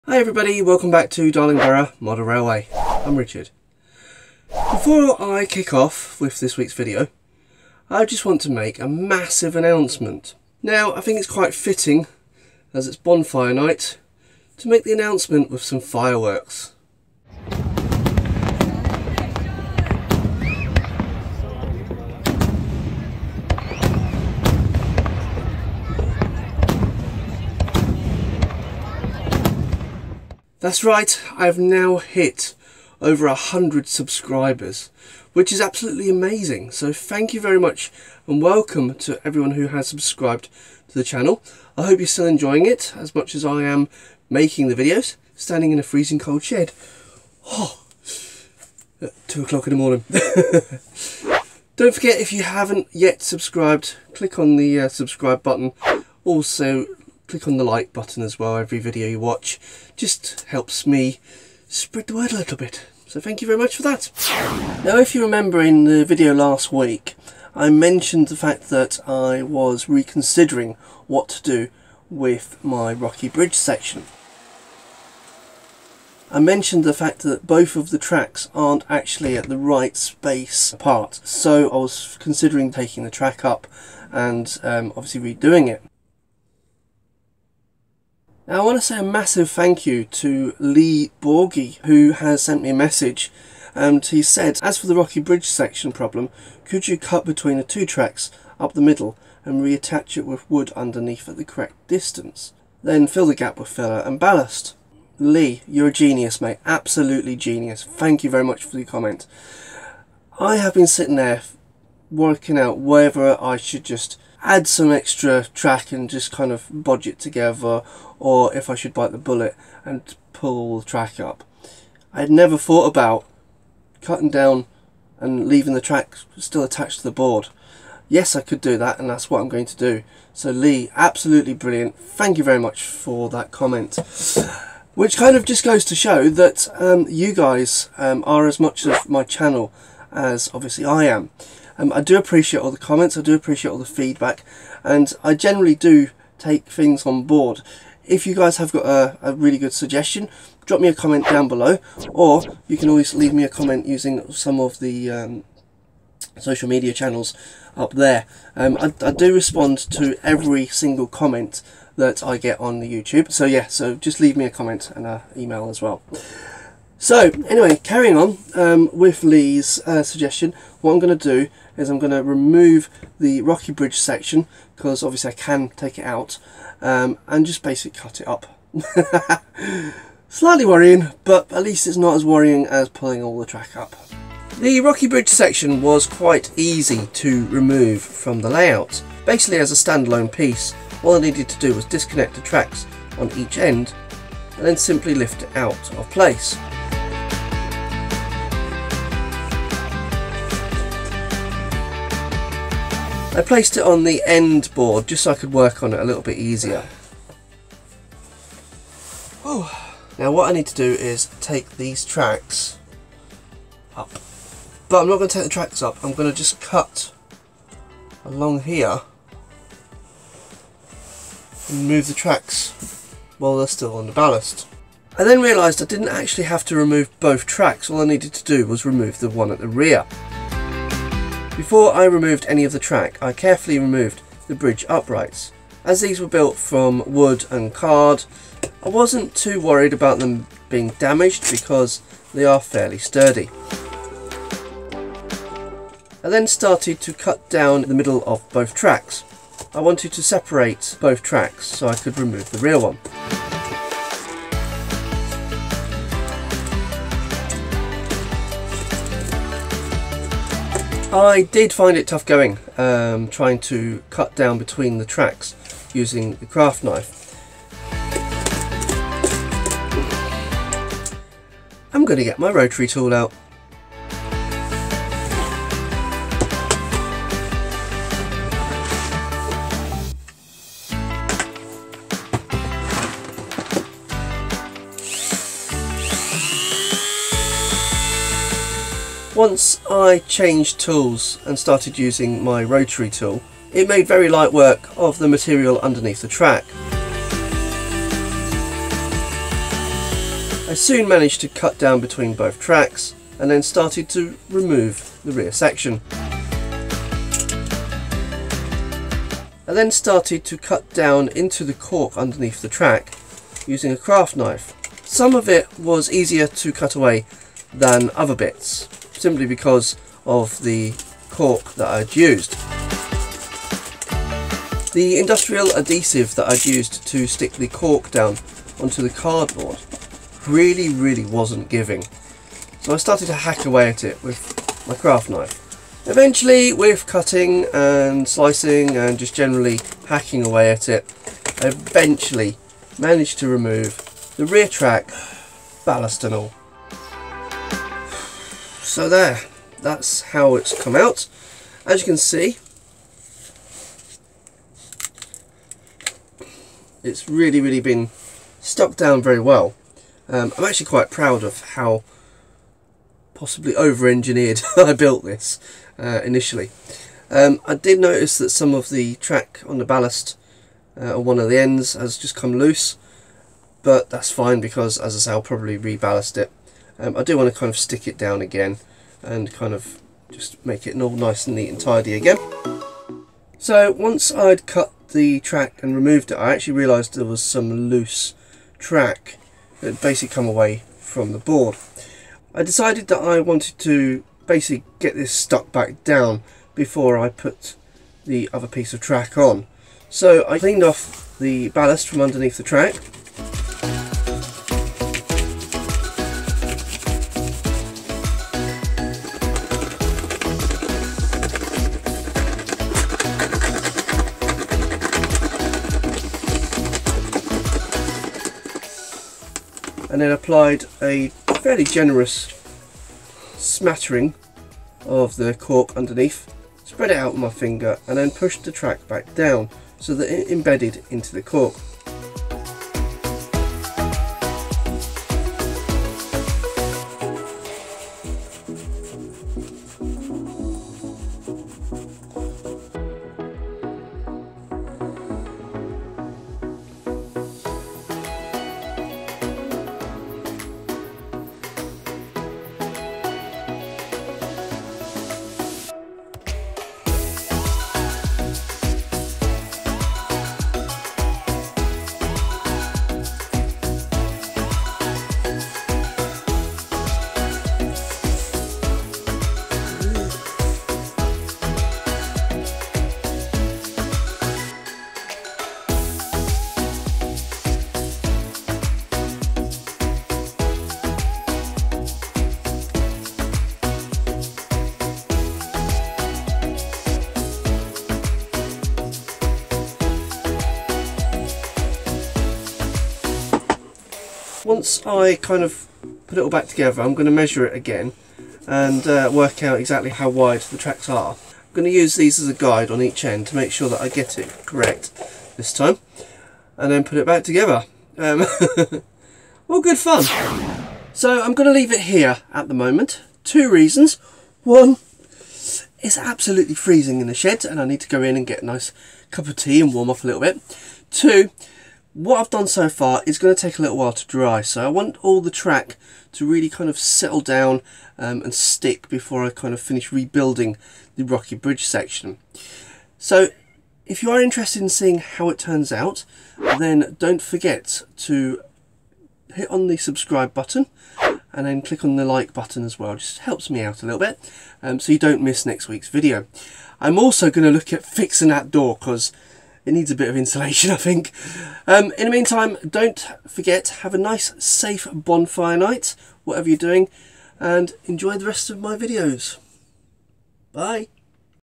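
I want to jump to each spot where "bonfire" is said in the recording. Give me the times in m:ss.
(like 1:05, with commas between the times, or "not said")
0:12, 9:15.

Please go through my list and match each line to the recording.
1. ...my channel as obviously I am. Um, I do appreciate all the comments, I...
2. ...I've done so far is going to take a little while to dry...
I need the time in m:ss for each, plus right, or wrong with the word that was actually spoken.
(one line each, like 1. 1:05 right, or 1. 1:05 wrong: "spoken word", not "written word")
1. 2:19 right
2. 8:42 right.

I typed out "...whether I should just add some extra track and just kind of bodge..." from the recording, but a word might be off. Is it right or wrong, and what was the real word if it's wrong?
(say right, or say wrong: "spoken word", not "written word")
right.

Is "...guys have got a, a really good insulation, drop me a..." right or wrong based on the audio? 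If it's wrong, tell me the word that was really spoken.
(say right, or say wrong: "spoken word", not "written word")
wrong: "suggestion", not "insulation".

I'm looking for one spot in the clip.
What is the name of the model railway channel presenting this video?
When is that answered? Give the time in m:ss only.
0:01.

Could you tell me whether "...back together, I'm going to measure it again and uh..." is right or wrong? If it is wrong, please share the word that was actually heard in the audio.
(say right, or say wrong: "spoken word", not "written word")
right.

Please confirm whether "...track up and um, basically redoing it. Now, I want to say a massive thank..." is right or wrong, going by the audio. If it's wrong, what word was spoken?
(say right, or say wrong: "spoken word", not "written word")
wrong: "obviously", not "basically".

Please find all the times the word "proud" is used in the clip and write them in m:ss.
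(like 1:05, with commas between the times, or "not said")
6:01.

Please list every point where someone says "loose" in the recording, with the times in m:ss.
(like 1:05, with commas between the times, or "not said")
6:12, 6:27.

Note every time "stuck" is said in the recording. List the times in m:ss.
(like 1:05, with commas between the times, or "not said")
5:58, 6:35.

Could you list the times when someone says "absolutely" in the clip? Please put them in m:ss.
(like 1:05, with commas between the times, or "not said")
0:35, 1:46, 2:10, 8:36.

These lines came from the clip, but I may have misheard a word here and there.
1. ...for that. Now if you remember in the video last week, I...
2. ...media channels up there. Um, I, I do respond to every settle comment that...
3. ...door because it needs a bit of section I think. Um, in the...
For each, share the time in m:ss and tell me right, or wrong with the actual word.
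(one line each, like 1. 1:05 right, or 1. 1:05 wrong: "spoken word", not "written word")
1. 1:03 right
2. 2:36 wrong: "single", not "settle"
3. 9:08 wrong: "insulation", not "section".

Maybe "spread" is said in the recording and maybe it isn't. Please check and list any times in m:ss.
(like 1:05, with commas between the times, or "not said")
1:01, 7:06.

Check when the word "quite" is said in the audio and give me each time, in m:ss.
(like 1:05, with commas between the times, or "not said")
0:11, 3:06, 6:00.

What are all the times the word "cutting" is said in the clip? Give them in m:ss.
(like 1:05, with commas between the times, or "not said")
2:04, 5:37.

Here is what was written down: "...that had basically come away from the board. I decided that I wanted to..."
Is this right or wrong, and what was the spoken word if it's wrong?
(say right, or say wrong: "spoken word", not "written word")
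right.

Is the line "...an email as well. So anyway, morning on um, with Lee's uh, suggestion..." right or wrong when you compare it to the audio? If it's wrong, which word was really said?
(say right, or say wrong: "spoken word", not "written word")
wrong: "carrying", not "morning".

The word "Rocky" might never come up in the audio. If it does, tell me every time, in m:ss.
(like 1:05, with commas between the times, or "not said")
1:12, 1:34, 2:53, 3:04, 8:51.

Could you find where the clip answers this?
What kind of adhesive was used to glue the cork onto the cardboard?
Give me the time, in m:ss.
5:25.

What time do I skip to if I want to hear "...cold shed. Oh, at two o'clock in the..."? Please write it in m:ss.
0:46.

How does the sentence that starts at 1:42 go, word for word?
Then fill the gap with filler and ballast.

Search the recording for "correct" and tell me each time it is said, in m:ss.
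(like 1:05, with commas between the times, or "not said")
1:41, 8:24.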